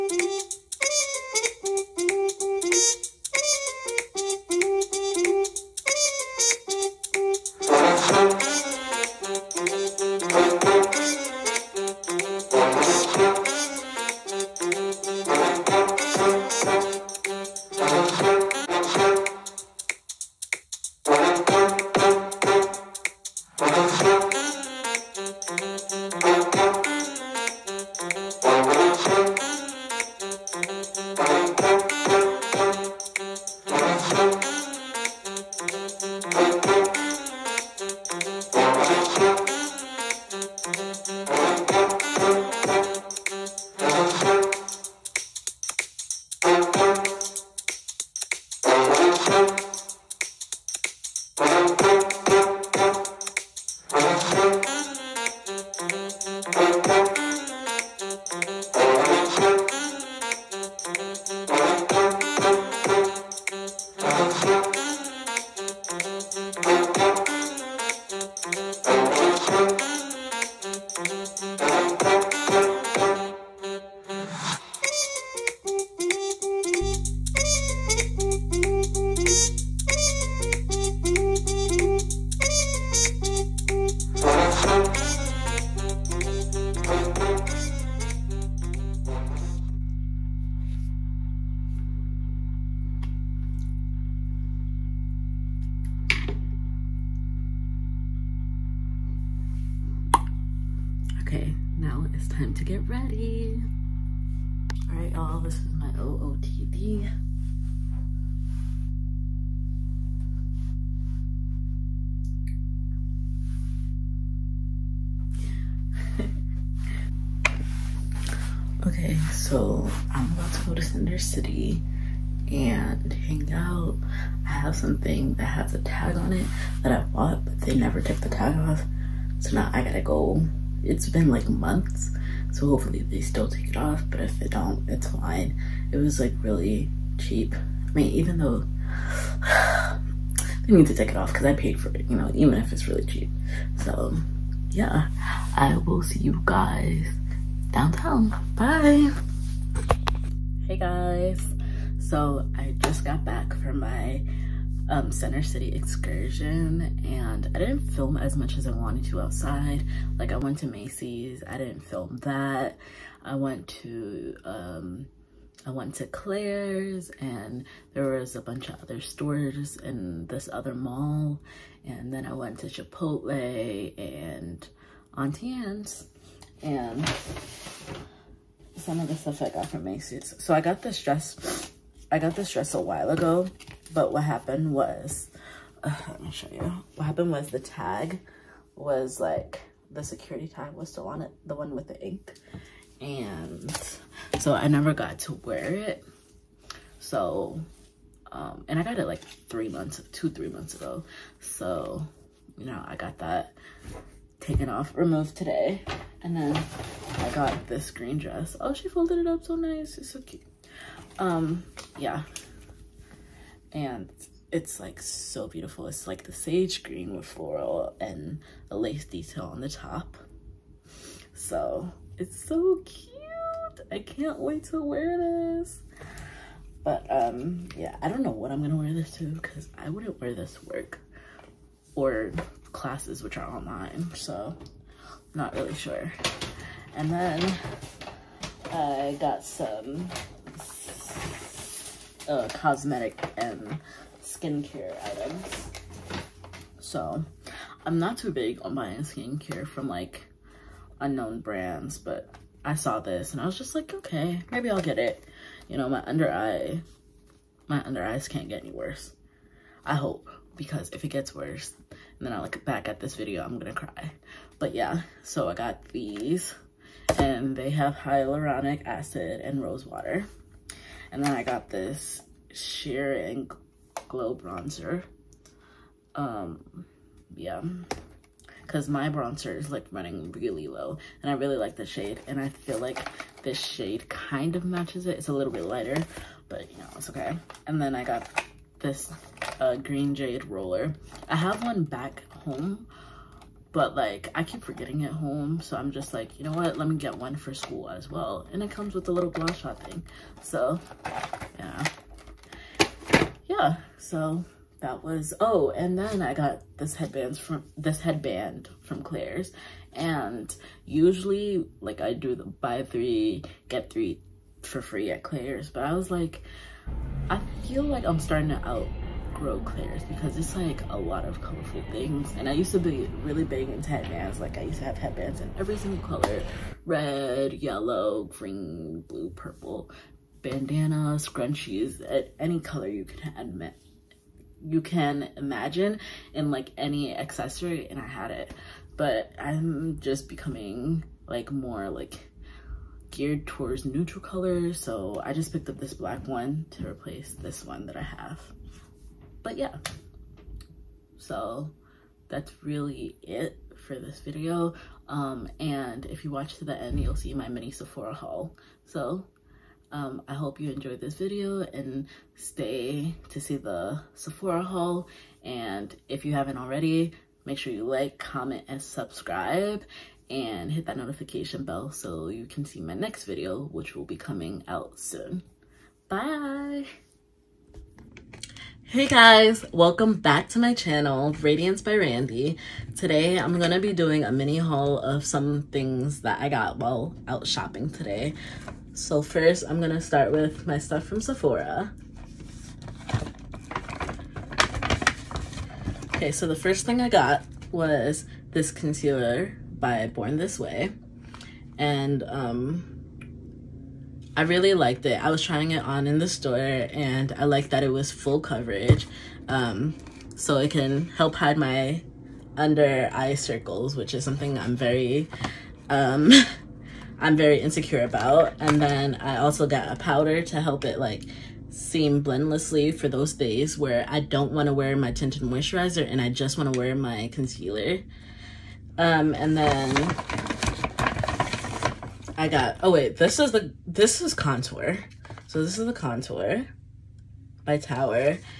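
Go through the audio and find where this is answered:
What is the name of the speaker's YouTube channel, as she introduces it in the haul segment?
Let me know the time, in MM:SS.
06:21.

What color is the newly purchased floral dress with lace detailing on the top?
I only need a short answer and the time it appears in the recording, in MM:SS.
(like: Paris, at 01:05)
sage green, at 03:36.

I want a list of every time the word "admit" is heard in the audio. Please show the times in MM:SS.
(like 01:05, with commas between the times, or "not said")
05:33.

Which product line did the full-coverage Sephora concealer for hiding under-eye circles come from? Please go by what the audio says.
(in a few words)
Born This Way.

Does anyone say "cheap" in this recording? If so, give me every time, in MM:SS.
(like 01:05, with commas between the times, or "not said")
02:17, 02:23.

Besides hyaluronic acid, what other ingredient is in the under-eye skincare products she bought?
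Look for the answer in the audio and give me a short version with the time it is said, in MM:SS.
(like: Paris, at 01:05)
rose water, at 04:29.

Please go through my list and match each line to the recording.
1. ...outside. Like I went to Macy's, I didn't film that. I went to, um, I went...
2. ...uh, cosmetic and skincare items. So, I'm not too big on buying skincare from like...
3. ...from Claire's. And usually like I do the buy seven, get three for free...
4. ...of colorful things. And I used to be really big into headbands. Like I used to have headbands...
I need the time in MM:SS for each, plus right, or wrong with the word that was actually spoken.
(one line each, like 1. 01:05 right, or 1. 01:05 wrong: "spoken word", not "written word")
1. 02:39 right
2. 04:02 right
3. 05:08 wrong: "three", not "seven"
4. 05:21 right.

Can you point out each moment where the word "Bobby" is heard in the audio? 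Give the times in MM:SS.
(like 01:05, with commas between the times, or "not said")
not said.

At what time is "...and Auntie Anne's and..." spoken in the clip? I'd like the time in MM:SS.
02:53.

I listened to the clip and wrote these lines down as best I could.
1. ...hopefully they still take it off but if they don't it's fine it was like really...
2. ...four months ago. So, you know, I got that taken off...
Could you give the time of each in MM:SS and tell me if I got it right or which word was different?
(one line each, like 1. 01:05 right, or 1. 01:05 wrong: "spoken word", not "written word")
1. 02:12 right
2. 03:20 wrong: "three", not "four".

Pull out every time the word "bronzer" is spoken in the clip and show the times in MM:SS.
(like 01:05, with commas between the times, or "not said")
04:34, 04:39.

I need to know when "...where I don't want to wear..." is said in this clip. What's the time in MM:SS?
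07:03.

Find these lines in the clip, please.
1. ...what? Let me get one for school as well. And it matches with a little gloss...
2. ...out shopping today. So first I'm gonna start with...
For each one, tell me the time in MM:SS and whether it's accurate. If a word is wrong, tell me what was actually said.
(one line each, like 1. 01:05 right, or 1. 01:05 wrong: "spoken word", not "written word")
1. 04:56 wrong: "comes", not "matches"
2. 06:27 right.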